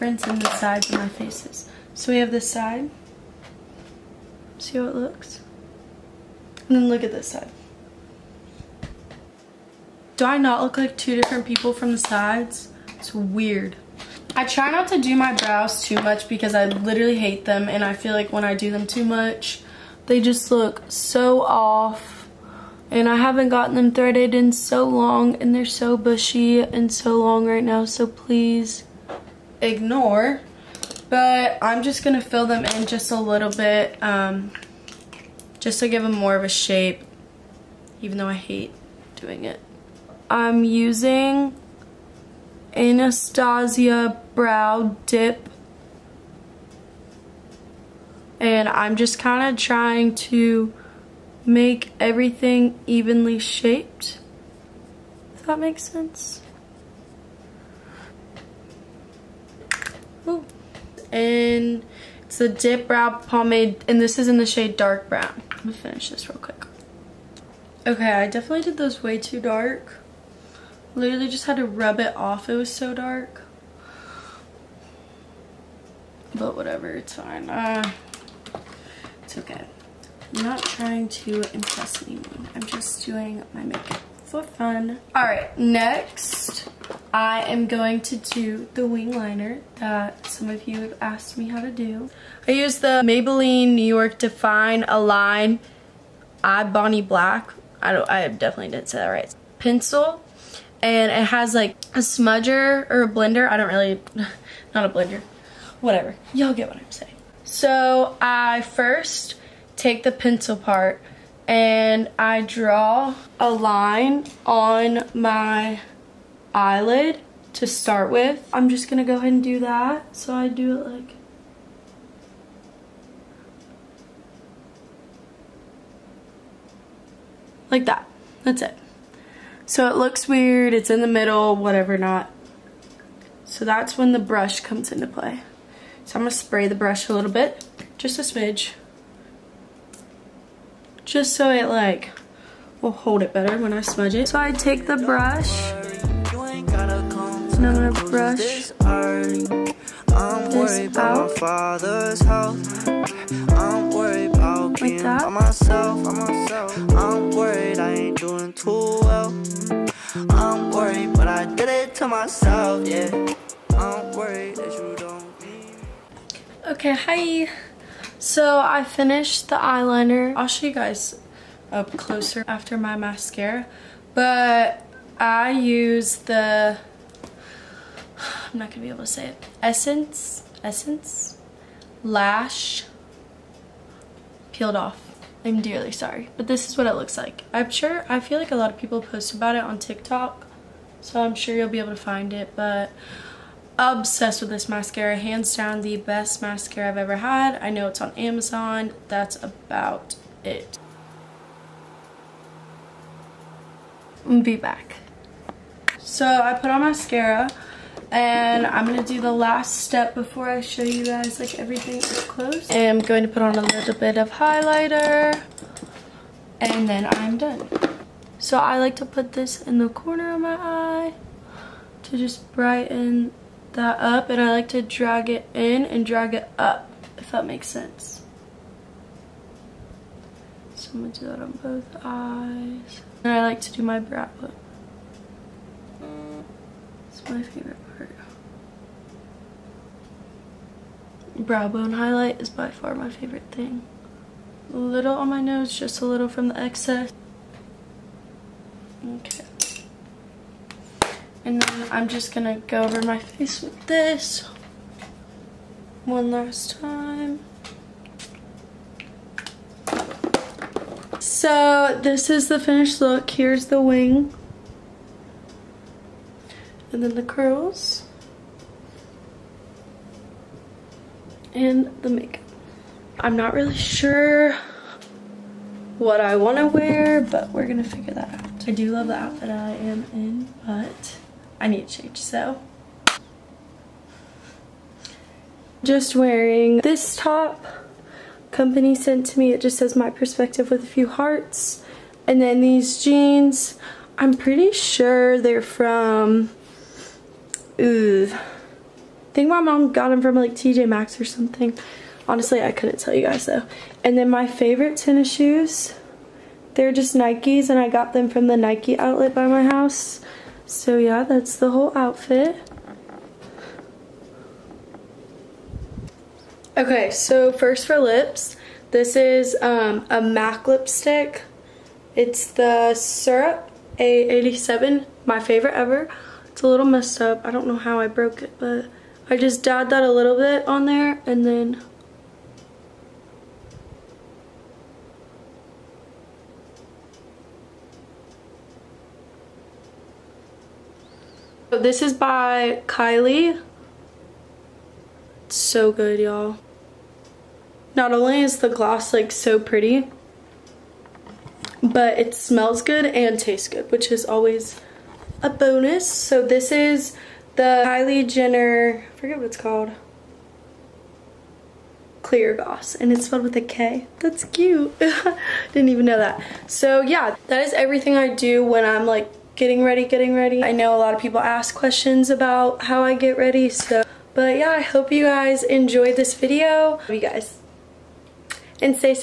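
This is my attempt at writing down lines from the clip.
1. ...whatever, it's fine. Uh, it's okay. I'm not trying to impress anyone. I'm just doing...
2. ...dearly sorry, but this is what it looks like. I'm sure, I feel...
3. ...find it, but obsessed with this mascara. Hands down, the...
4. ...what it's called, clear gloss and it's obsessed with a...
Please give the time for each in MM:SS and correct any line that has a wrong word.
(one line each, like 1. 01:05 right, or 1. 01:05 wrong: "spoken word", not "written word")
1. 01:16 right
2. 03:05 right
3. 03:11 right
4. 05:59 wrong: "spelled", not "obsessed".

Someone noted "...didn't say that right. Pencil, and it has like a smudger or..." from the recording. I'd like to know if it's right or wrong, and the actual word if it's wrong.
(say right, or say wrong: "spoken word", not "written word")
right.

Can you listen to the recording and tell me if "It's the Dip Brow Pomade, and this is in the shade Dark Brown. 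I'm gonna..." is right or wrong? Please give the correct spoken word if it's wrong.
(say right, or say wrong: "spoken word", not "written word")
right.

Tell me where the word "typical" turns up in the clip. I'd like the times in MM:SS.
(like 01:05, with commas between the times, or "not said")
not said.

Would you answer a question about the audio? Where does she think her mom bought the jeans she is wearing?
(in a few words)
TJ Maxx.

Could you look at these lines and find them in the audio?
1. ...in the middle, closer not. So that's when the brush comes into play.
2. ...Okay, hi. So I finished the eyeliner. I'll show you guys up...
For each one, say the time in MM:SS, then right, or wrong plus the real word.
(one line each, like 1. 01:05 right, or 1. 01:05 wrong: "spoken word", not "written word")
1. 02:10 wrong: "whatever", not "closer"
2. 02:46 right.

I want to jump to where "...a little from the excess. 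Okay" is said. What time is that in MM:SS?
04:06.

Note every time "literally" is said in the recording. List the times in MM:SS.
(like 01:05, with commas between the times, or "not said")
00:16, 01:10.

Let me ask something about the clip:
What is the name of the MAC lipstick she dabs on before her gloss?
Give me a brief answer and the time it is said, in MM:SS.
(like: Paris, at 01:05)
Syrup, at 05:22.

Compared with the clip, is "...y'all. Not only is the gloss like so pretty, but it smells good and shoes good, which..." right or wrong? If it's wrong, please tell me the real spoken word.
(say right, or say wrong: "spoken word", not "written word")
wrong: "tastes", not "shoes".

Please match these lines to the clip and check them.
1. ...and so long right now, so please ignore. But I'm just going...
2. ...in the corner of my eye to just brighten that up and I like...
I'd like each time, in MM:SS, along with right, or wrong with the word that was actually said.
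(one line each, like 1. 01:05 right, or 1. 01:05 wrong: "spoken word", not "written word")
1. 00:26 right
2. 03:39 right.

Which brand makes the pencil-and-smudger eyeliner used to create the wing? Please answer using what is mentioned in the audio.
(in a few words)
Maybelline New York.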